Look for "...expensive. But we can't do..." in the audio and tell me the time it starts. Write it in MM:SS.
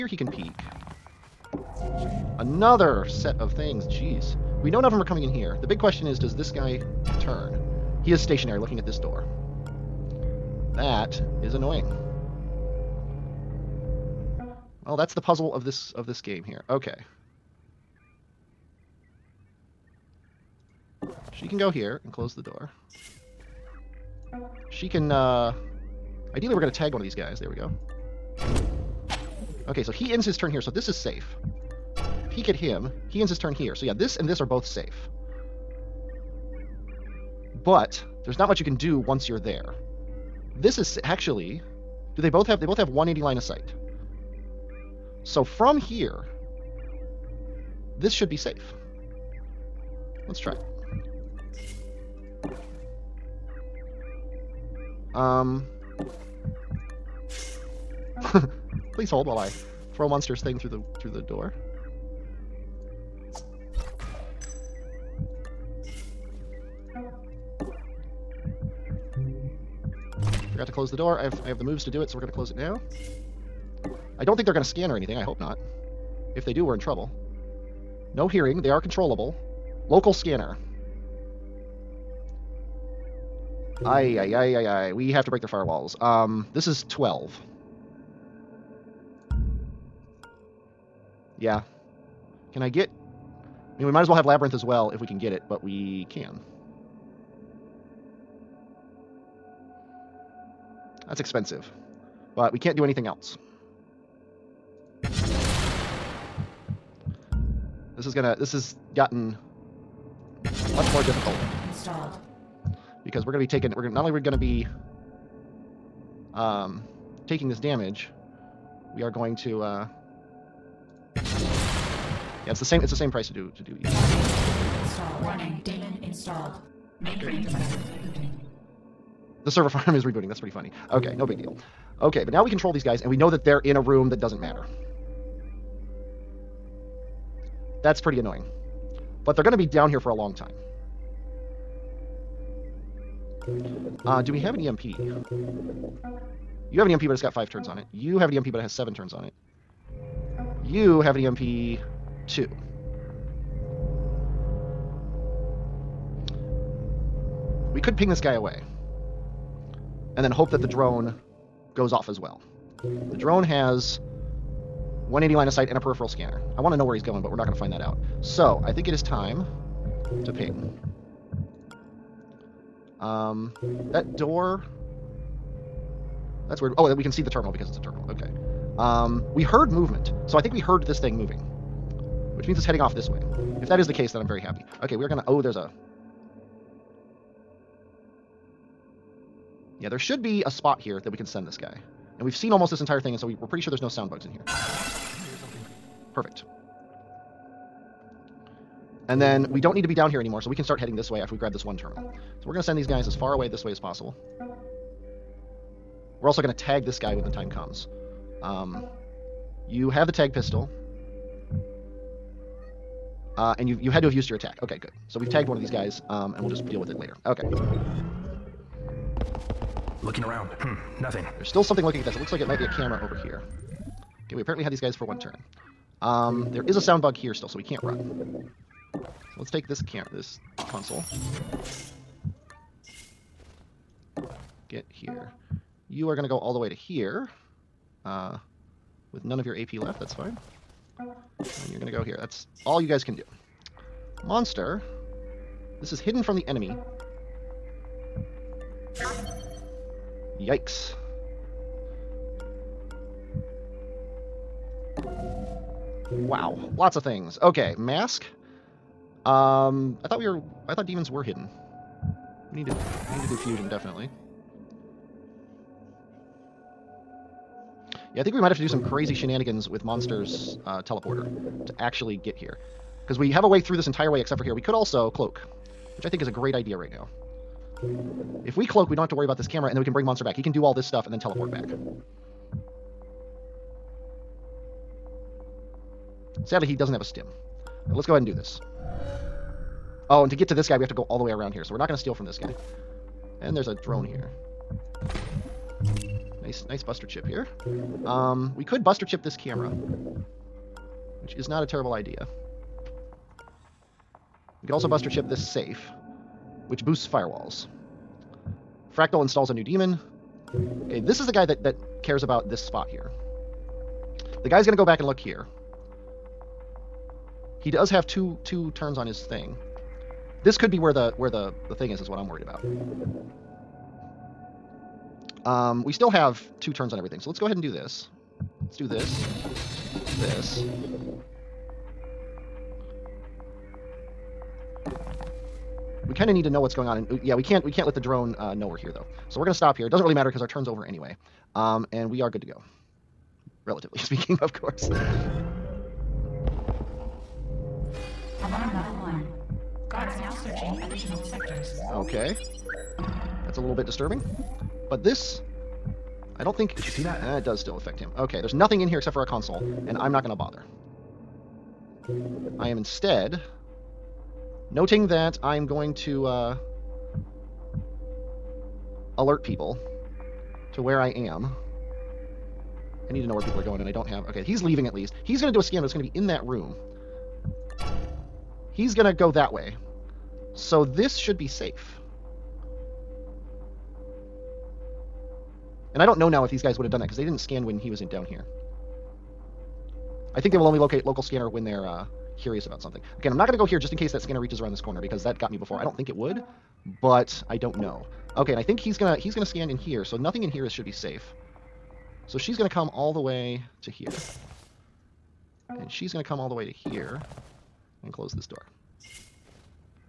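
01:41.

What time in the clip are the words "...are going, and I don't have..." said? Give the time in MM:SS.
06:13.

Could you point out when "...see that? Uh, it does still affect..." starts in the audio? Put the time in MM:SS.
05:56.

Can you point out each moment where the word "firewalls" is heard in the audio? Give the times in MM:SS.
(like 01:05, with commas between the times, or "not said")
01:25, 05:07.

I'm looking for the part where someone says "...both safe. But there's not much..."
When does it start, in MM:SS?
00:34.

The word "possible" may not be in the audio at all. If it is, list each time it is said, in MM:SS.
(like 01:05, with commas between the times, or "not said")
03:23.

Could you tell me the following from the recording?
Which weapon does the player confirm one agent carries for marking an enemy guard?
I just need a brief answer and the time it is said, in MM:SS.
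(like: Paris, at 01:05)
Tag pistol, at 03:30.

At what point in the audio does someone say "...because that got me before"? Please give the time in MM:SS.
06:34.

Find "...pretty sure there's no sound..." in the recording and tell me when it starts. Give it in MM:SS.
03:13.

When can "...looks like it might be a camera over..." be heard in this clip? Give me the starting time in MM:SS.
03:42.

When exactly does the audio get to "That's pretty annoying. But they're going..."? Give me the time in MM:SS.
02:17.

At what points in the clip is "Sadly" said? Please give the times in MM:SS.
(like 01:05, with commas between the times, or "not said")
04:46.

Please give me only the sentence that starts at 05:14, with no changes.
The guy's going to go back and look here.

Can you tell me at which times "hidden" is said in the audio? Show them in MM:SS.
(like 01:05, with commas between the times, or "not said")
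04:05, 04:21.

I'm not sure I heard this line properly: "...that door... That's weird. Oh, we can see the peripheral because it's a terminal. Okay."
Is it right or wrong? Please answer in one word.
wrong.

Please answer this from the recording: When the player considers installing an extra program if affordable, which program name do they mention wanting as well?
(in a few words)
Labyrinth.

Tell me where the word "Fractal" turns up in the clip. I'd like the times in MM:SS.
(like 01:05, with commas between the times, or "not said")
05:08.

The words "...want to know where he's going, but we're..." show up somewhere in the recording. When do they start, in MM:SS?
02:46.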